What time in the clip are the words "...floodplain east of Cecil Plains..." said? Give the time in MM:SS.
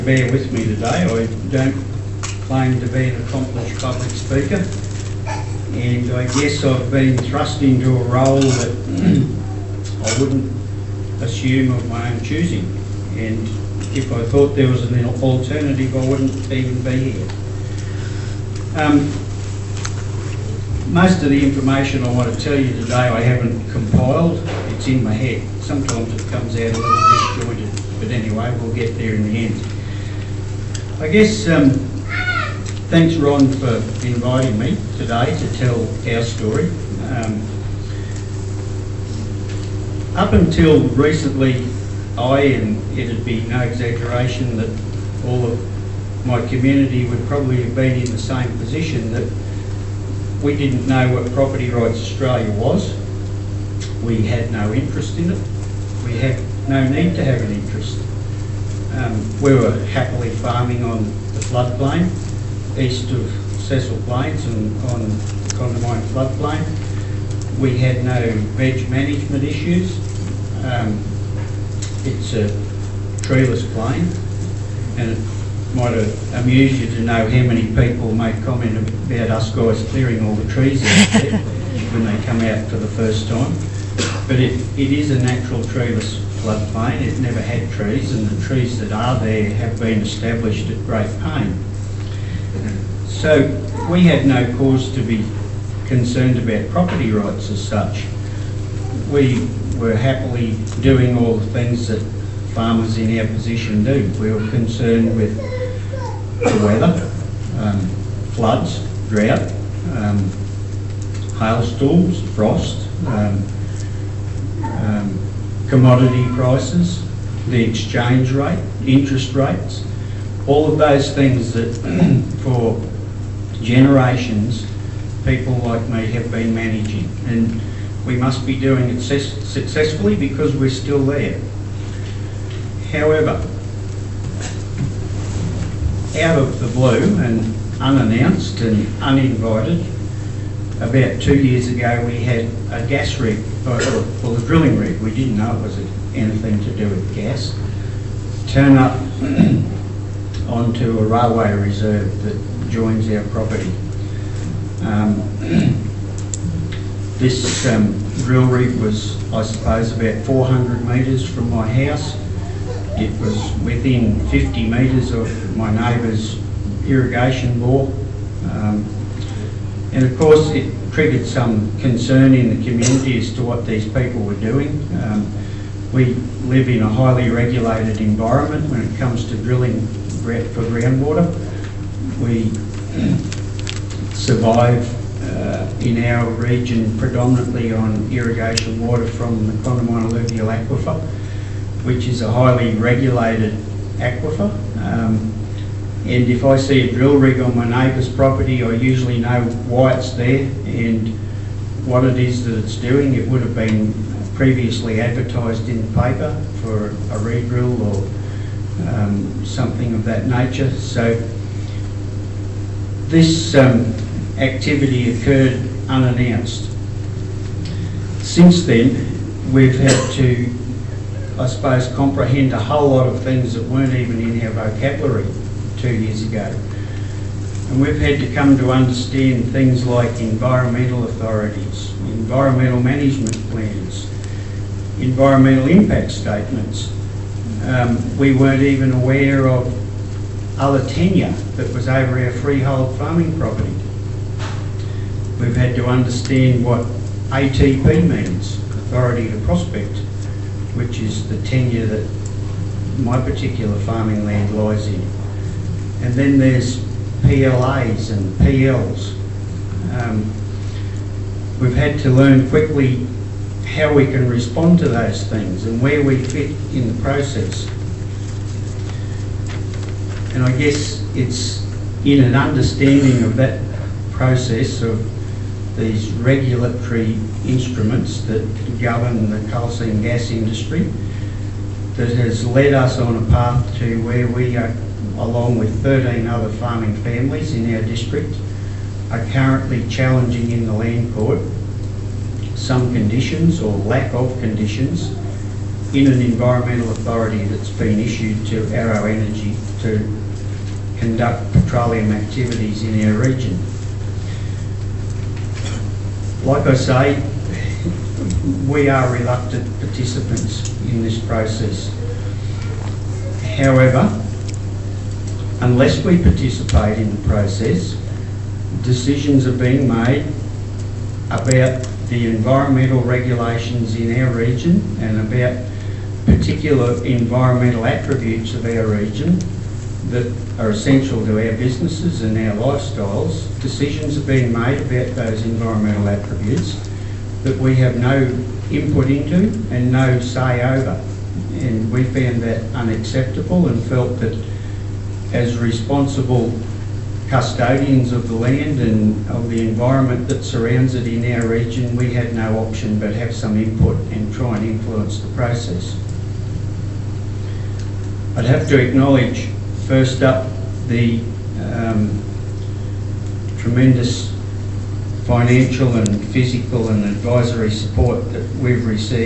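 01:01.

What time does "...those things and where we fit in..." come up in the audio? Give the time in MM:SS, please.
04:24.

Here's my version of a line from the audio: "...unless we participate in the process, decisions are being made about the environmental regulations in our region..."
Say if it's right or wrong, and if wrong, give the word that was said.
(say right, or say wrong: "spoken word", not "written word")
right.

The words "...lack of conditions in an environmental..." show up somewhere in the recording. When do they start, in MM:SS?
04:53.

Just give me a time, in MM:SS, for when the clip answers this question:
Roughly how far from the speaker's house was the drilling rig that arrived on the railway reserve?
02:40.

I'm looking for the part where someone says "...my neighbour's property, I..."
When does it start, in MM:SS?
03:17.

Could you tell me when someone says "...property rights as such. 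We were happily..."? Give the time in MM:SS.
01:36.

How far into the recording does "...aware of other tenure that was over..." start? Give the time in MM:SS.
03:58.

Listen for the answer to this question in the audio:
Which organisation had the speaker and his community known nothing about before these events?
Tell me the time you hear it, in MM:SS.
00:51.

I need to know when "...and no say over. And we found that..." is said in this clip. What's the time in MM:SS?
05:39.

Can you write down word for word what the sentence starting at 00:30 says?
I guess, um, thanks Ron for inviting me today to tell our story.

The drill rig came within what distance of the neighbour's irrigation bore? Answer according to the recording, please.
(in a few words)
50 metres.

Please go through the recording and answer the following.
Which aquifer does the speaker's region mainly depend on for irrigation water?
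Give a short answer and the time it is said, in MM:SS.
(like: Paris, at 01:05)
Condamine alluvial aquifer, at 03:09.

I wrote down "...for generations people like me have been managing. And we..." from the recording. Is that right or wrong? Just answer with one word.
right.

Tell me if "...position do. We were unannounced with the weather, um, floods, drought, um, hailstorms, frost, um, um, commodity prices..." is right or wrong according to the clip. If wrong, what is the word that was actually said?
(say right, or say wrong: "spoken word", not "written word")
wrong: "concerned", not "unannounced".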